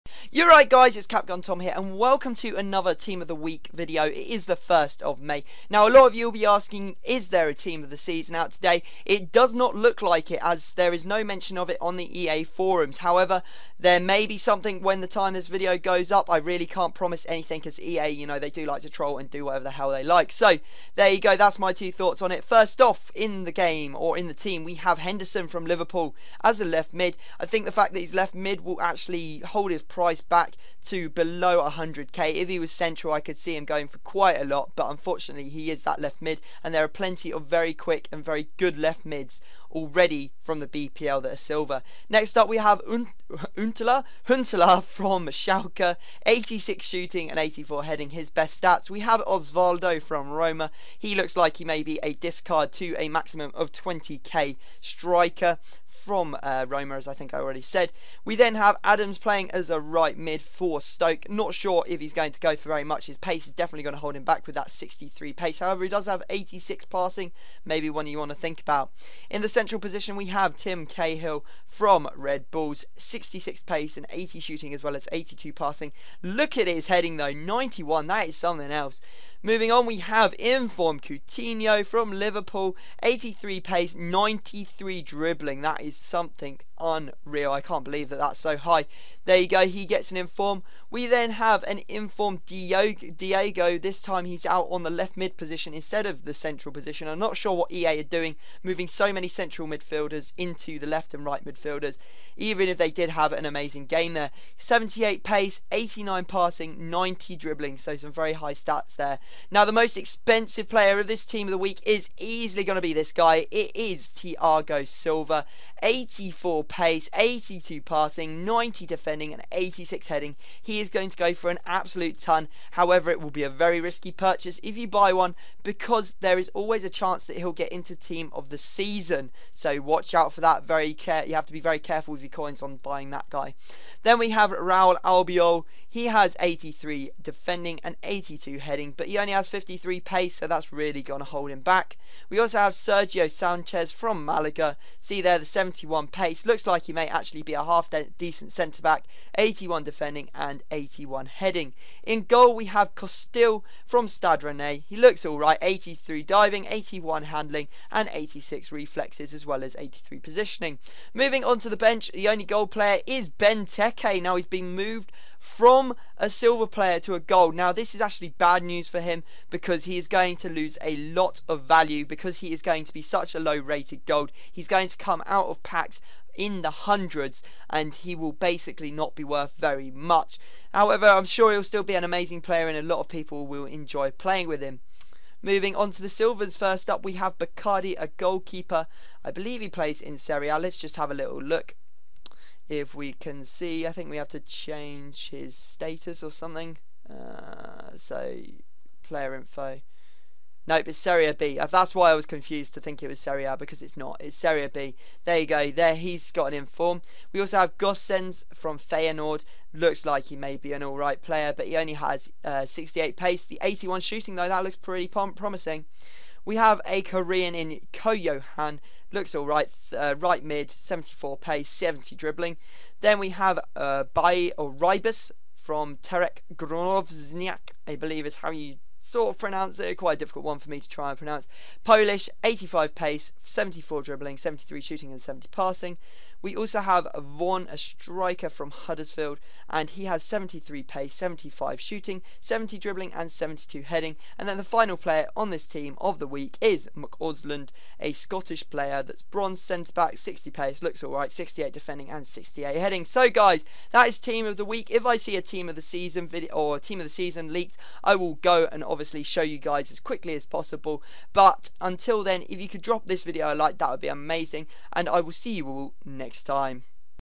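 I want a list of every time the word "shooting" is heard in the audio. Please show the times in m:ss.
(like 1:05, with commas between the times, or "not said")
0:46, 1:14, 3:34, 3:54, 4:01.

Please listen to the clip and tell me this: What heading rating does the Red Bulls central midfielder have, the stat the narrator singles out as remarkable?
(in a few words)
91.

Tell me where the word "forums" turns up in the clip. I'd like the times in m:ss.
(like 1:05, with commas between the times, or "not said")
0:12.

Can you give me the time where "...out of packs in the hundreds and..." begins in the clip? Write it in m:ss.
2:55.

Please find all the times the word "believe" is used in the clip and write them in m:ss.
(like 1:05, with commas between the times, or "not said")
1:27, 3:09, 3:47.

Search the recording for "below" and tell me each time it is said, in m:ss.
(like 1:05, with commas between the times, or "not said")
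0:31.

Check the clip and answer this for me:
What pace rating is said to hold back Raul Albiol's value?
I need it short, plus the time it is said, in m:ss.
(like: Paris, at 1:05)
53, at 2:19.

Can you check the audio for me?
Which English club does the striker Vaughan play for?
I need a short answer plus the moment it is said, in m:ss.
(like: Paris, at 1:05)
Huddersfield, at 3:58.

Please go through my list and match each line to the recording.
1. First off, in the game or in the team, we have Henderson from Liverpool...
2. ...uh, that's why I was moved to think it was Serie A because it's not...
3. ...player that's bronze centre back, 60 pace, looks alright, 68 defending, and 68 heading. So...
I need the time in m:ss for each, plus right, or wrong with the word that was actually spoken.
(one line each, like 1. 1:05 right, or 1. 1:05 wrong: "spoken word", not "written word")
1. 0:22 right
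2. 3:21 wrong: "confused", not "moved"
3. 4:08 right.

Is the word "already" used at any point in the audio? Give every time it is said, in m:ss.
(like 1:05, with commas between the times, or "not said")
0:39, 0:57.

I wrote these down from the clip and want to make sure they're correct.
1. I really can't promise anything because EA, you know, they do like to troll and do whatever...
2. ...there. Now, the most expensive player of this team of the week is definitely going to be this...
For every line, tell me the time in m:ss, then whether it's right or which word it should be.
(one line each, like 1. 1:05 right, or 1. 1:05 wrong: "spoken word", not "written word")
1. 0:16 right
2. 1:48 wrong: "easily", not "definitely".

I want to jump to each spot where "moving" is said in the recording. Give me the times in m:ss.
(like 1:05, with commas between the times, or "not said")
1:19, 1:38, 2:41, 3:05.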